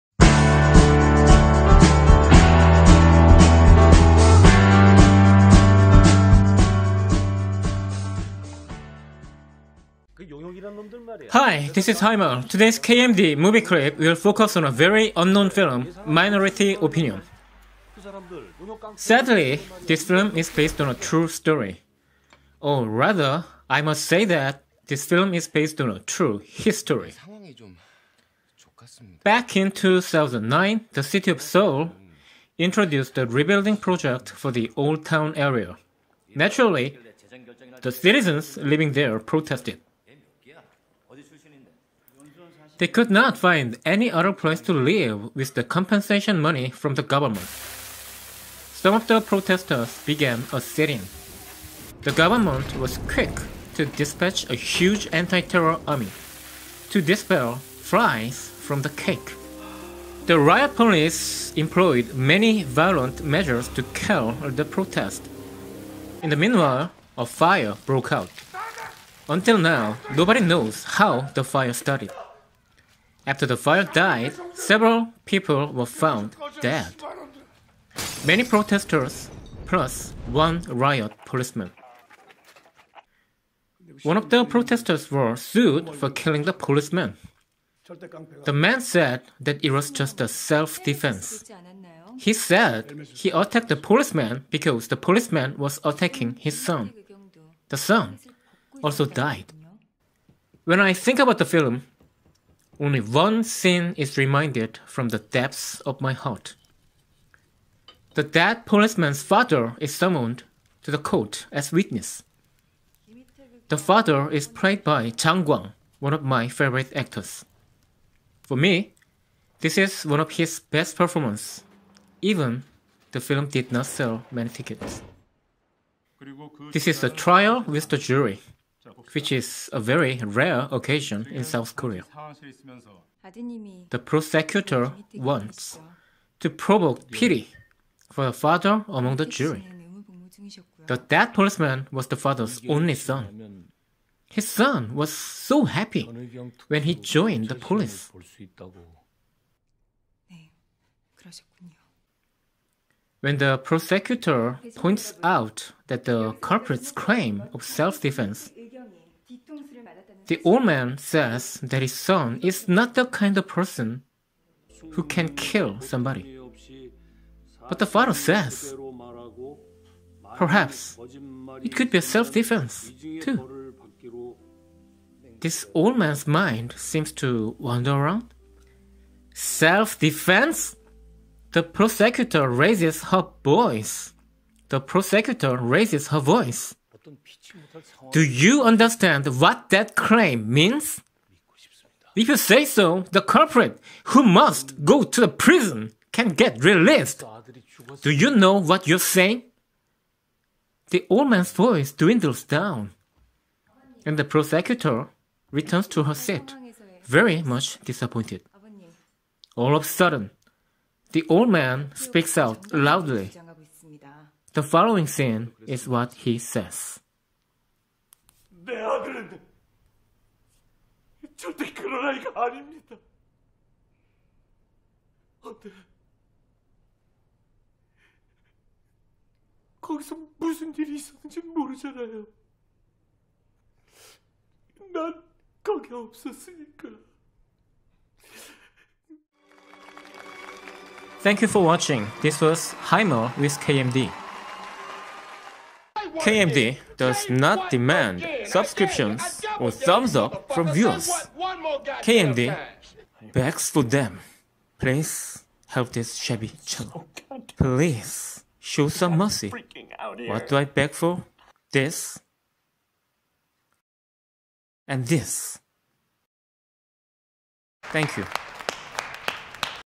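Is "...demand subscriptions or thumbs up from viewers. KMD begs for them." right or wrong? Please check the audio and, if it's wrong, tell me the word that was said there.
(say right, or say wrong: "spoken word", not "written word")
right.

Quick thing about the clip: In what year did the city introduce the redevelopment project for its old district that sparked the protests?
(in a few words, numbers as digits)
2009.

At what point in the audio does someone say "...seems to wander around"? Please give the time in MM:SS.
02:56.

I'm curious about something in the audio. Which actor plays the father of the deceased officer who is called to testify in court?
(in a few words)
Jang Gwang.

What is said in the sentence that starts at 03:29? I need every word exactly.
All of a sudden, the old man speaks out loudly.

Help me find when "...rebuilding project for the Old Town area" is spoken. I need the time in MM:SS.
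00:33.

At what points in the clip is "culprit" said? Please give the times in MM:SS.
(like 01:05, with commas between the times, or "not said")
02:36, 03:13.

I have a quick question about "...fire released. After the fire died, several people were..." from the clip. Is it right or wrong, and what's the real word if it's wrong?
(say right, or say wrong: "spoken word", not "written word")
wrong: "started", not "released".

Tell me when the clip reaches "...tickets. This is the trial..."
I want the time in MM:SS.
02:04.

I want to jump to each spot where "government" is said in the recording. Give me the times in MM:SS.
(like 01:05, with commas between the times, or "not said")
00:47, 00:52.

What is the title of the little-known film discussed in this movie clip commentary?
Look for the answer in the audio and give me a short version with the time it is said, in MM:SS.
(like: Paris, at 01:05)
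Minority Opinion, at 00:16.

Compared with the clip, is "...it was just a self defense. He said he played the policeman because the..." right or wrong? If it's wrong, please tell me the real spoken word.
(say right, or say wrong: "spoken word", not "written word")
wrong: "attacked", not "played".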